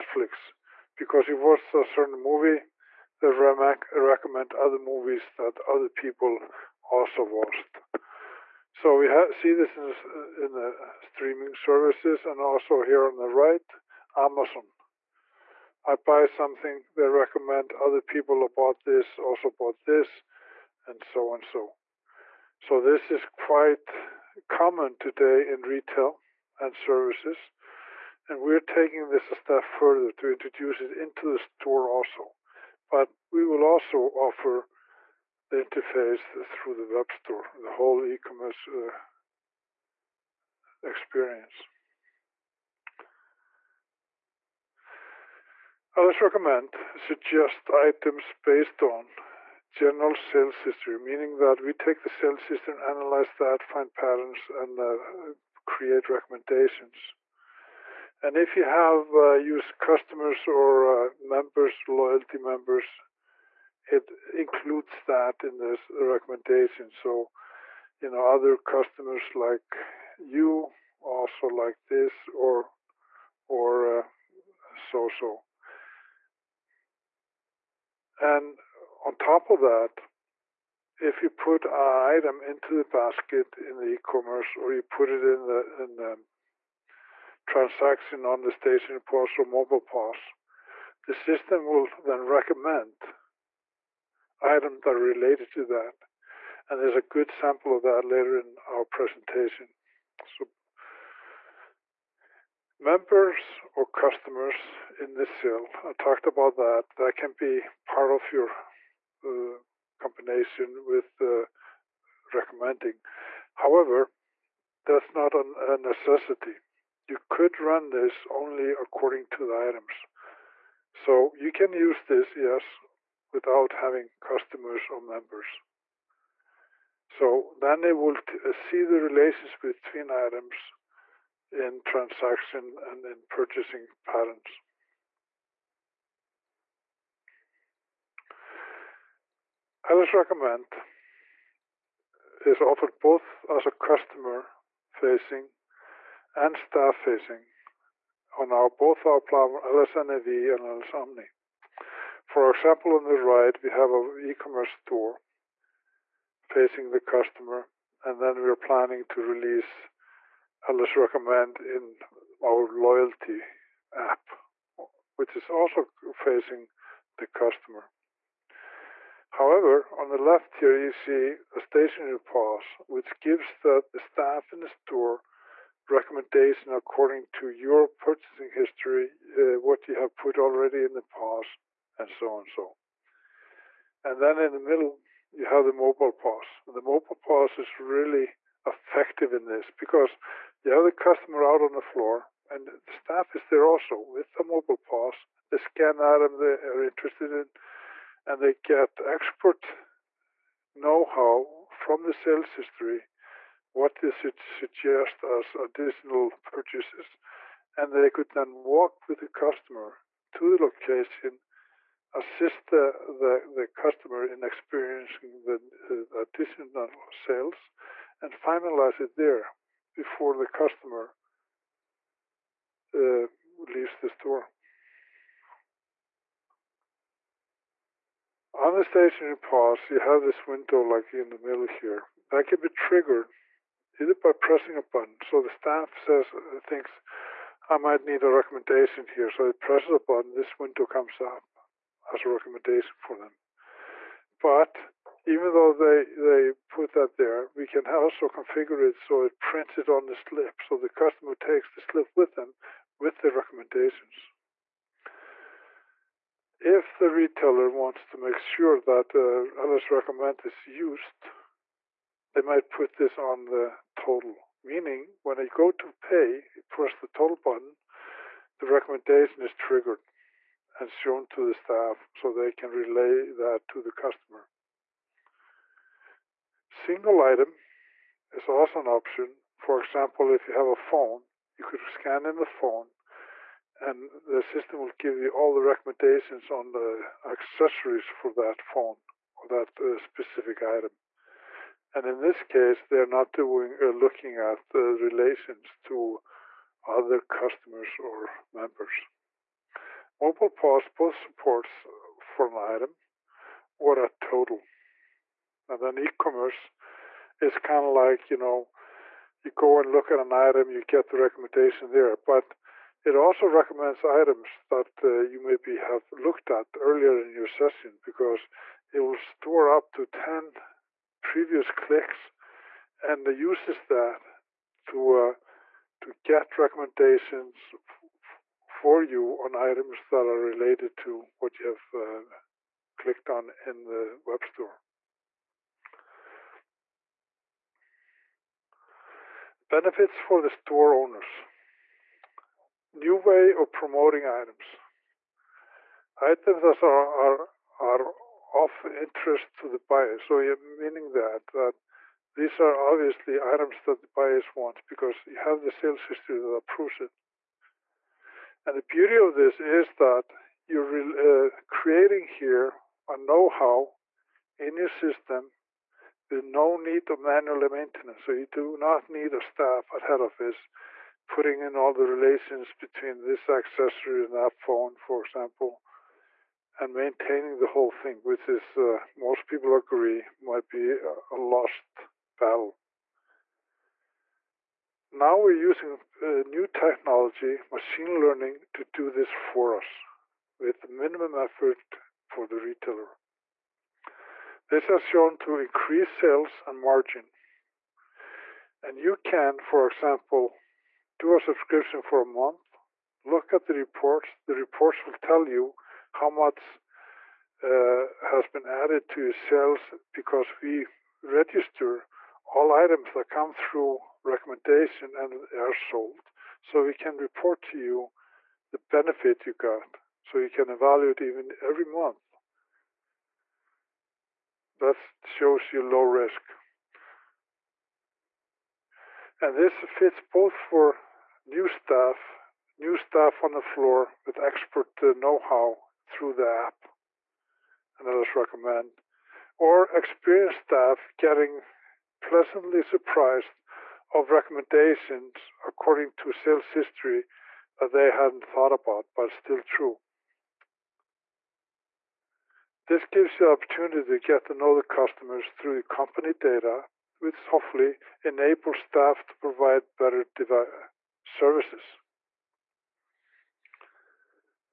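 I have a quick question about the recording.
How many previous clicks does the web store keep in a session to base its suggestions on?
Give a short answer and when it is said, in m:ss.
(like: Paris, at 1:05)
10, at 5:20.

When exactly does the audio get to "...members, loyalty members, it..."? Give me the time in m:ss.
1:01.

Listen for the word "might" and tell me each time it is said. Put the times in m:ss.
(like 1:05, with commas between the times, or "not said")
3:57, 4:22, 6:20.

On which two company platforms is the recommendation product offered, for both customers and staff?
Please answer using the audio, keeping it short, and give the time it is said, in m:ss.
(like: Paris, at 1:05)
LSNAV and Omni, at 2:29.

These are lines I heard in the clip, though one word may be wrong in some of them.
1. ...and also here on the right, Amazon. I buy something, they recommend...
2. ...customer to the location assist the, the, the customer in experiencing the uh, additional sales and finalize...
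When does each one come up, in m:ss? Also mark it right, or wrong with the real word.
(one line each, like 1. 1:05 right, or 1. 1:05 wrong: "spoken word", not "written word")
1. 0:12 right
2. 3:29 right.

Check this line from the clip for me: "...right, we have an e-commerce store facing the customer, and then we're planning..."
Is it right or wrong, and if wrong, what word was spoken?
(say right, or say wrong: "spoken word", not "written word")
right.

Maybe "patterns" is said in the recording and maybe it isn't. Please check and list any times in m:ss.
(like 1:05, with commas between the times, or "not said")
0:53, 2:14.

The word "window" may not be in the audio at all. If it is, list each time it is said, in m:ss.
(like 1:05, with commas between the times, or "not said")
3:50, 4:00.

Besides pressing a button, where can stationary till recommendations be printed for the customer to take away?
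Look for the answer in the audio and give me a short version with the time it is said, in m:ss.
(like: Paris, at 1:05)
on the slip, at 4:09.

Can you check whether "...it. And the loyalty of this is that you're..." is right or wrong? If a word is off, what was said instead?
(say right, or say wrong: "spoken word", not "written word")
wrong: "beauty", not "loyalty".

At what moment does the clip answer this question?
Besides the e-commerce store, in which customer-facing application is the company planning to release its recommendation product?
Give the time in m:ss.
2:42.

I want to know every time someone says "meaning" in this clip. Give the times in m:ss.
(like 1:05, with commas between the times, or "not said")
0:50, 4:24, 5:50.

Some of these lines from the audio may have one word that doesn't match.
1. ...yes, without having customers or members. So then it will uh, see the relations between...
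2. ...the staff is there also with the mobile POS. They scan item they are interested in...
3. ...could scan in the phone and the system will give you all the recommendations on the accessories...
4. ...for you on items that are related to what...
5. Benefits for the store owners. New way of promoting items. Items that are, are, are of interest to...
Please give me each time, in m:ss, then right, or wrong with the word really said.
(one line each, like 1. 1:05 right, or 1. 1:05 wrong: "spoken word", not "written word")
1. 2:02 right
2. 3:12 right
3. 4:41 right
4. 5:28 right
5. 5:39 right.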